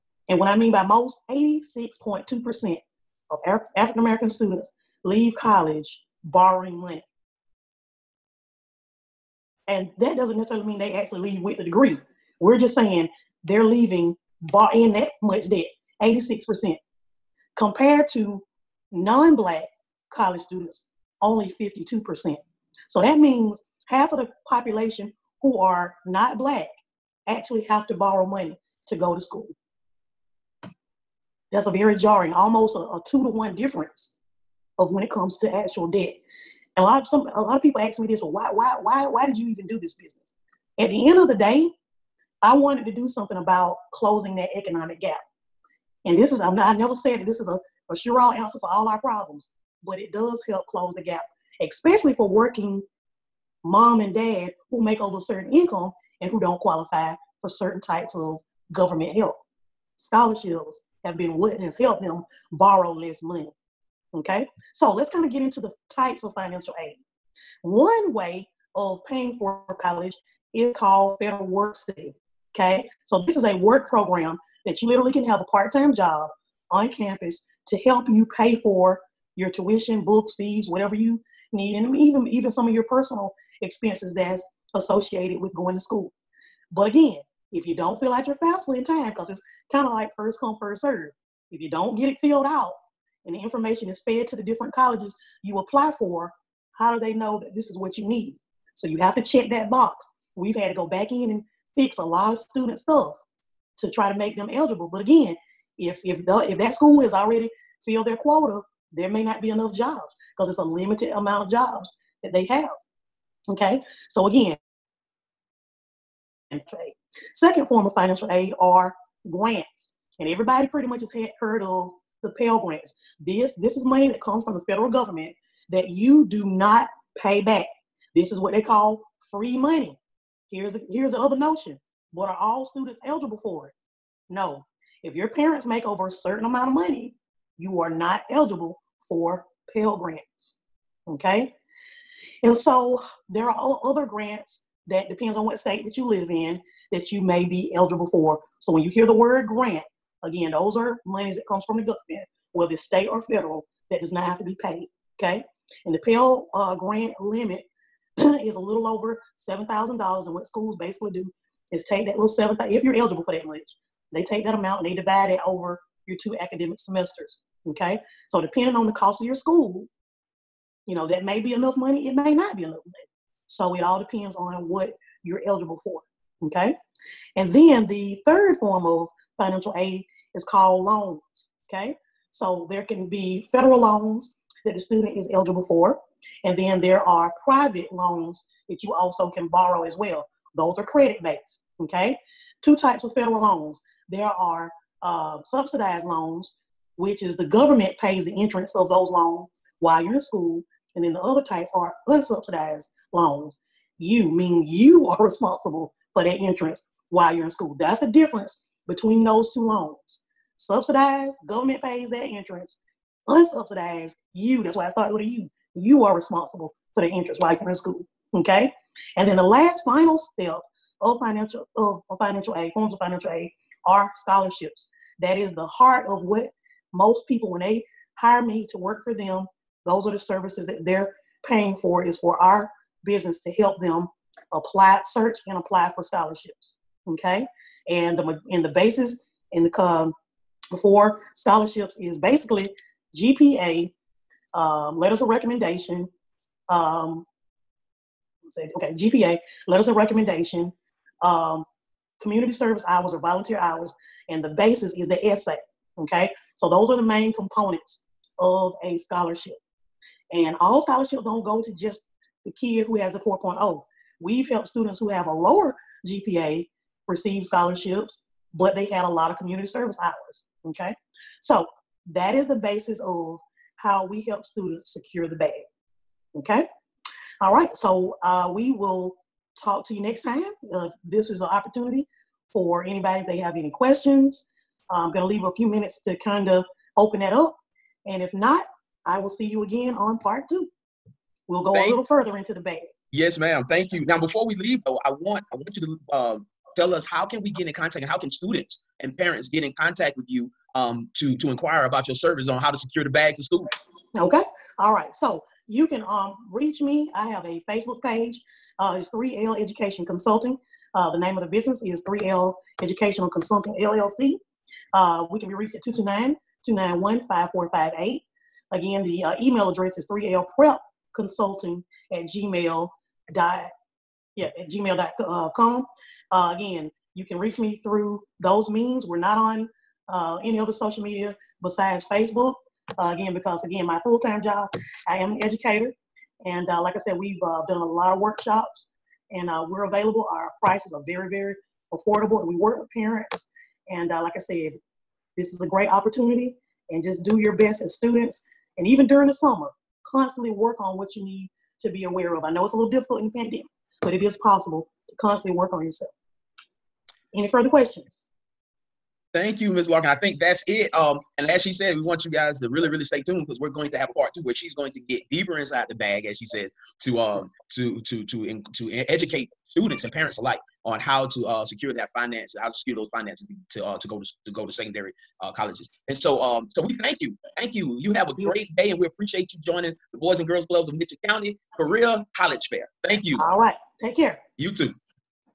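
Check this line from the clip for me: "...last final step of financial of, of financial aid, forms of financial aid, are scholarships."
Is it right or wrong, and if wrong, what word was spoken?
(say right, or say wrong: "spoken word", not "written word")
right.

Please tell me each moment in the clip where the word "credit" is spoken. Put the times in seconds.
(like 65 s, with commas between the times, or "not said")
190 s.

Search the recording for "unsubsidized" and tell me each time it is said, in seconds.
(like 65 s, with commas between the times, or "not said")
202 s, 213 s.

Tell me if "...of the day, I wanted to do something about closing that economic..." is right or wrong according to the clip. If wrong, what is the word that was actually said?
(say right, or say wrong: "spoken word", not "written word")
right.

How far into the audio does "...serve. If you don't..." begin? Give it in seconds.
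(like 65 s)
90 s.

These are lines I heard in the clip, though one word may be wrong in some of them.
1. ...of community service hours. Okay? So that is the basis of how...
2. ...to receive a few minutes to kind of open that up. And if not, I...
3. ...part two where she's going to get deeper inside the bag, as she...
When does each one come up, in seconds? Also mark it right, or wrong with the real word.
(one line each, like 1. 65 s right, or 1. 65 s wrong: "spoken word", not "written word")
1. 269 s right
2. 285 s wrong: "leave", not "receive"
3. 364 s right.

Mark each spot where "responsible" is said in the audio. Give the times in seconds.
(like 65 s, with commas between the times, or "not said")
205 s, 216 s.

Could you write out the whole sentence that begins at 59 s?
Scholarships have been what has helped them borrow less money.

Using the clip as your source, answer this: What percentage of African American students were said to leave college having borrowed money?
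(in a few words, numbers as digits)
86.2%.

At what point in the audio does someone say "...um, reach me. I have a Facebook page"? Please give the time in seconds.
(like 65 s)
306 s.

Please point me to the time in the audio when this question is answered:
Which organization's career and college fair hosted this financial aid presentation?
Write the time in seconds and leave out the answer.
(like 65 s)
380 s.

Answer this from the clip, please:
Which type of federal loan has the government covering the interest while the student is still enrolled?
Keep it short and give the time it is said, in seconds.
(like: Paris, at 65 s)
subsidized loans, at 195 s.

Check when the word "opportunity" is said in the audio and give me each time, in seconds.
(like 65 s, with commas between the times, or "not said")
281 s, 345 s.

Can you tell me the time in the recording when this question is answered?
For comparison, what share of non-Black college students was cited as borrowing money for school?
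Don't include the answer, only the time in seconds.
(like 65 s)
21 s.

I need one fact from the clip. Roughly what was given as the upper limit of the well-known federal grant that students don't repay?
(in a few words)
a little over $7,000.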